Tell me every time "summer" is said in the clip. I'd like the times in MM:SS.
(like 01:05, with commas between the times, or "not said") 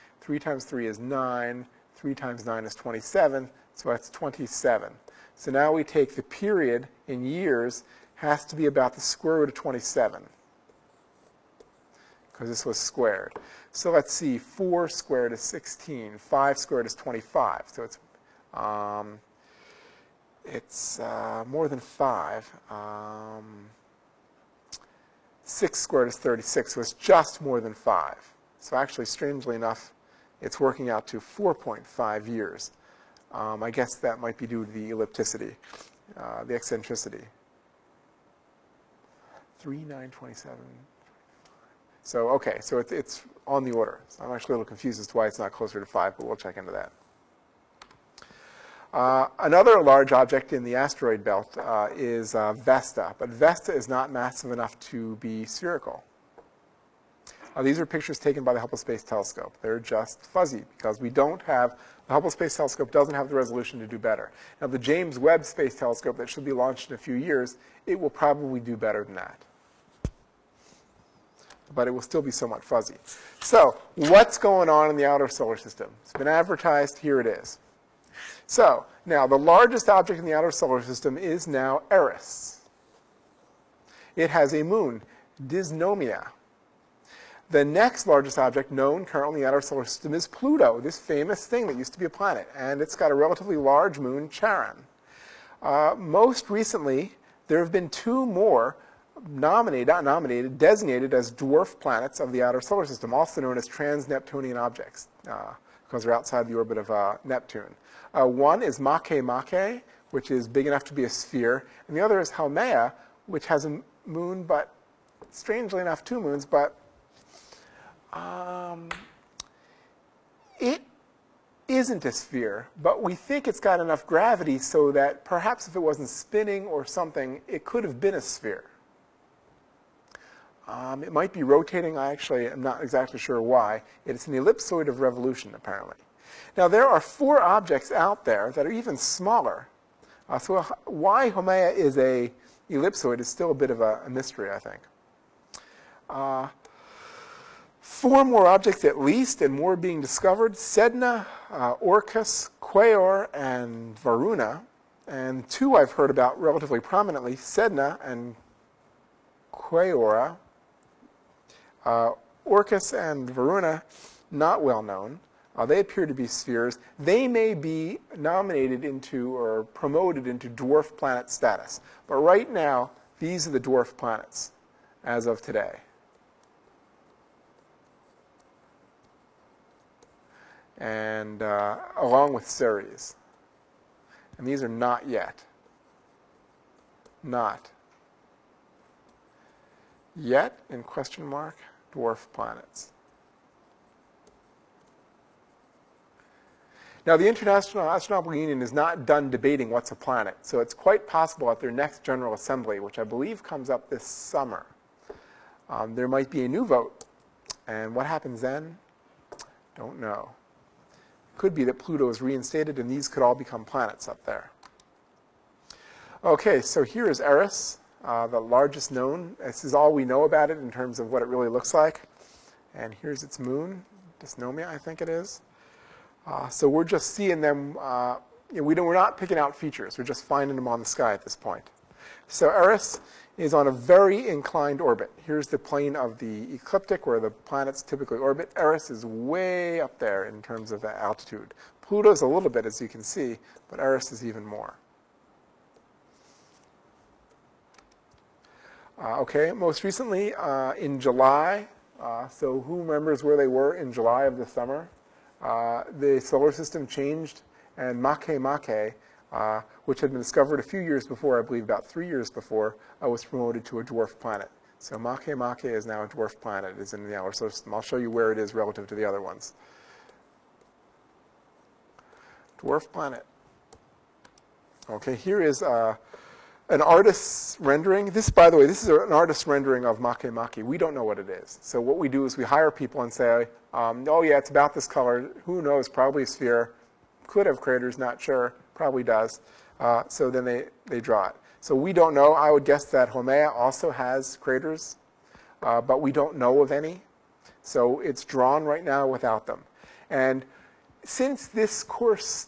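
03:24, 04:14.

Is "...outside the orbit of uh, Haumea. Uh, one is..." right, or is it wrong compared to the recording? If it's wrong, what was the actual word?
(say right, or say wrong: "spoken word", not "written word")
wrong: "Neptune", not "Haumea".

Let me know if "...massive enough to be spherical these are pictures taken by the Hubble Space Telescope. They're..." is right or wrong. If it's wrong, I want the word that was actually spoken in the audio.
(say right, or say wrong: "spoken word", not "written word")
right.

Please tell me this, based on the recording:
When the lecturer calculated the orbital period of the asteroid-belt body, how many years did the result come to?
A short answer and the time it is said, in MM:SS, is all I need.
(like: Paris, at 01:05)
4.5 years, at 00:31.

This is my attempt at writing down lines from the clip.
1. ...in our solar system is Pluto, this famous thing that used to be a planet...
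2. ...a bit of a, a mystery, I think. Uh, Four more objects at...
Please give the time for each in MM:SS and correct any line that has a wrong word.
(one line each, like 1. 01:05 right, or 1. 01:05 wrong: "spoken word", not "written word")
1. 01:29 right
2. 02:23 right.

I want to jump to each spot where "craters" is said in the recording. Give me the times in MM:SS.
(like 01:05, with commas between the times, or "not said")
04:47, 04:54.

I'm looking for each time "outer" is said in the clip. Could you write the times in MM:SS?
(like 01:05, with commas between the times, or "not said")
01:15, 01:20, 01:42, 04:27.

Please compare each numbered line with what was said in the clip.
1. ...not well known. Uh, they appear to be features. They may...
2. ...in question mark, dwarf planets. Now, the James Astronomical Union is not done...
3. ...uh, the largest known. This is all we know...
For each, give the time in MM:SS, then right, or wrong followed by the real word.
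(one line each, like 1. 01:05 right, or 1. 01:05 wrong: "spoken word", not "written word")
1. 02:44 wrong: "spheres", not "features"
2. 03:10 wrong: "International", not "James"
3. 03:38 right.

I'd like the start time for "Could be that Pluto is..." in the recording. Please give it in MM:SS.
03:31.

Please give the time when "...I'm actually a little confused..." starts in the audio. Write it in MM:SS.
00:44.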